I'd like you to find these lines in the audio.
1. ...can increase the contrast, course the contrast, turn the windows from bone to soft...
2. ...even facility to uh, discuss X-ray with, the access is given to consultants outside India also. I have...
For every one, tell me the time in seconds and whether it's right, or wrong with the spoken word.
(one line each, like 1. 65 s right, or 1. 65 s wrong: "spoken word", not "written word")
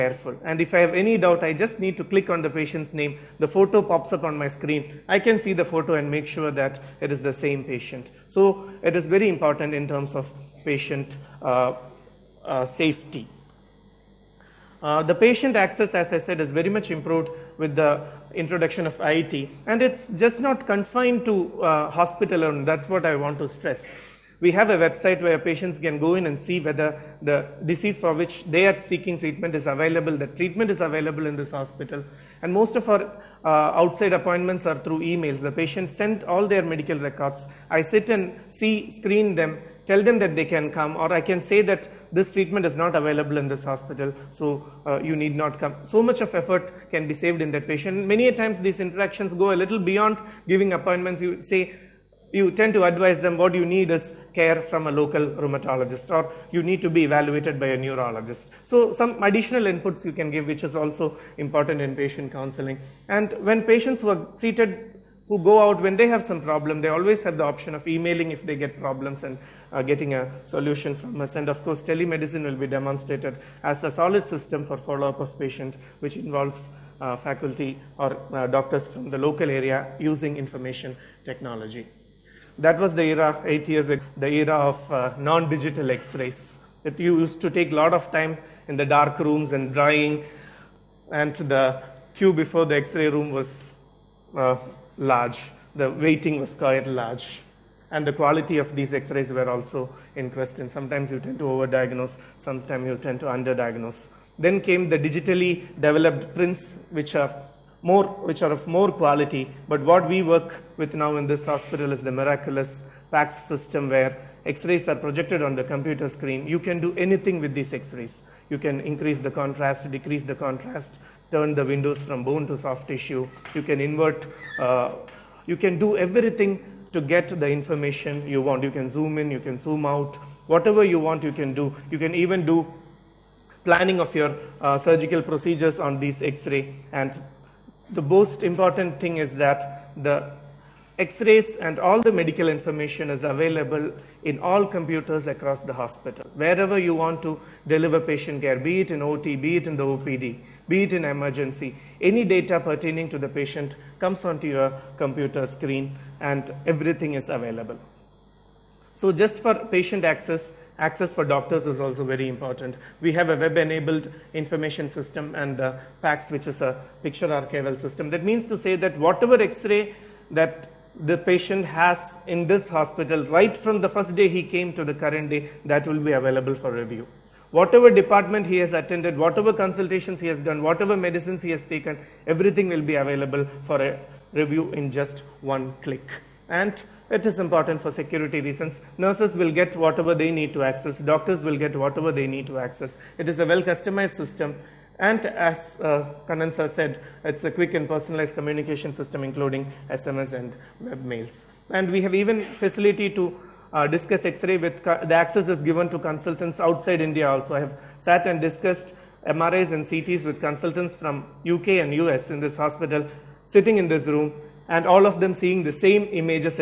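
1. 118 s wrong: "decrease", not "course"
2. 202 s right.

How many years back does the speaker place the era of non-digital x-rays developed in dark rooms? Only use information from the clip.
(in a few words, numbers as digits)
8.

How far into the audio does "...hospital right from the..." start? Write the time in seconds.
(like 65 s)
172 s.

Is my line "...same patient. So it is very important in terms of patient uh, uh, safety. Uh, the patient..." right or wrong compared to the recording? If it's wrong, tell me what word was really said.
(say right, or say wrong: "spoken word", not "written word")
right.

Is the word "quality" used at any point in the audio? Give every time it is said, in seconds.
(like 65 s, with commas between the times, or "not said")
98 s, 108 s.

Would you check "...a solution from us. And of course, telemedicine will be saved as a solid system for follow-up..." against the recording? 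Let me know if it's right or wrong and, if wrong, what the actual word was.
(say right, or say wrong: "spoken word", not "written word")
wrong: "demonstrated", not "saved".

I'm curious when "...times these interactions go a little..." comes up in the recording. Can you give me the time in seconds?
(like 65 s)
48 s.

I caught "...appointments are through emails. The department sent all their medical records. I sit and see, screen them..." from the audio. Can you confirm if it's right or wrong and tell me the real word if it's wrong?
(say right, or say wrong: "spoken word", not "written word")
wrong: "patient", not "department".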